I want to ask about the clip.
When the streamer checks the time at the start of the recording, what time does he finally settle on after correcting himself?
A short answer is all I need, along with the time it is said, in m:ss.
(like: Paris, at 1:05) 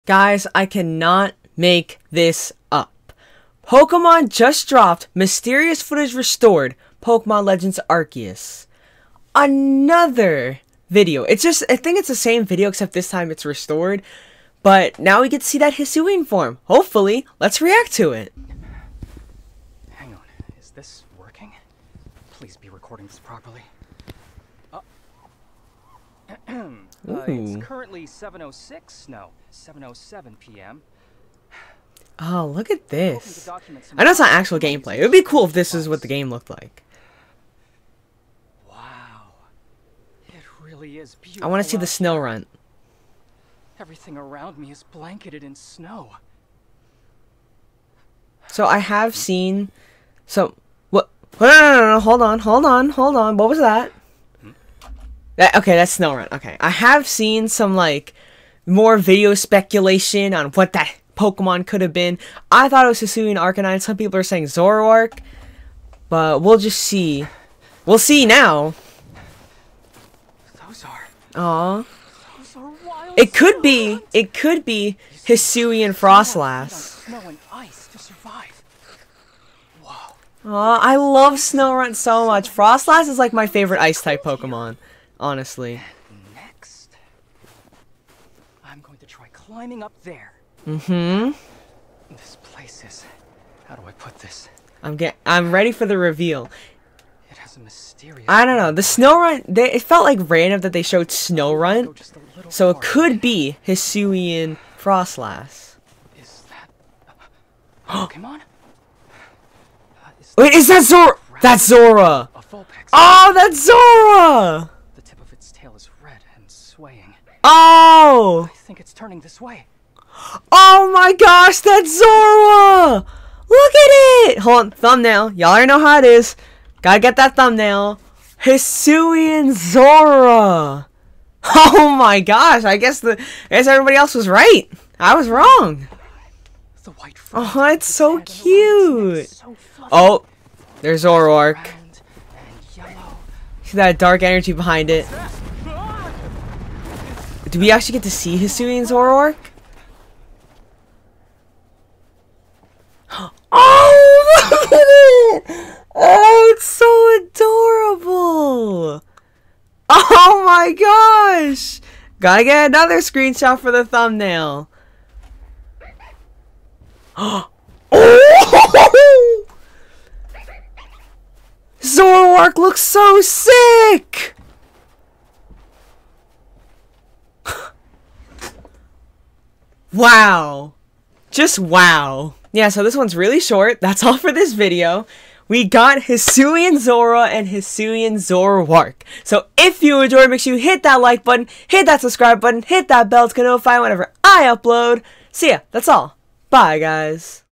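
7:07 p.m., at 0:29.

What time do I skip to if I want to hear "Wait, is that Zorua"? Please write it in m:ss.
1:50.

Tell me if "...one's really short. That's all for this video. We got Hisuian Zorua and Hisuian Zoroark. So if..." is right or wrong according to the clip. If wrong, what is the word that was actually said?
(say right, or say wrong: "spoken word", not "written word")
right.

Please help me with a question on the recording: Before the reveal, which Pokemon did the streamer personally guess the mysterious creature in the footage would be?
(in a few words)
Hisuian Arcanine.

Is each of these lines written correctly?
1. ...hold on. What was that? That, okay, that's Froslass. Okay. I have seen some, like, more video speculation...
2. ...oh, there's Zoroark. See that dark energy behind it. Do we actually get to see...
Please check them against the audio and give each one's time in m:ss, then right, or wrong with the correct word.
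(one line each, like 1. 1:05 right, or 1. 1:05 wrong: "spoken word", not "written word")
1. 0:52 wrong: "Snorunt", not "Froslass"
2. 2:19 right.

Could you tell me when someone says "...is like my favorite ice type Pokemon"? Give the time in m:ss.
1:23.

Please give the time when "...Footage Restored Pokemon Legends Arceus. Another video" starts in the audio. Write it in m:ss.
0:05.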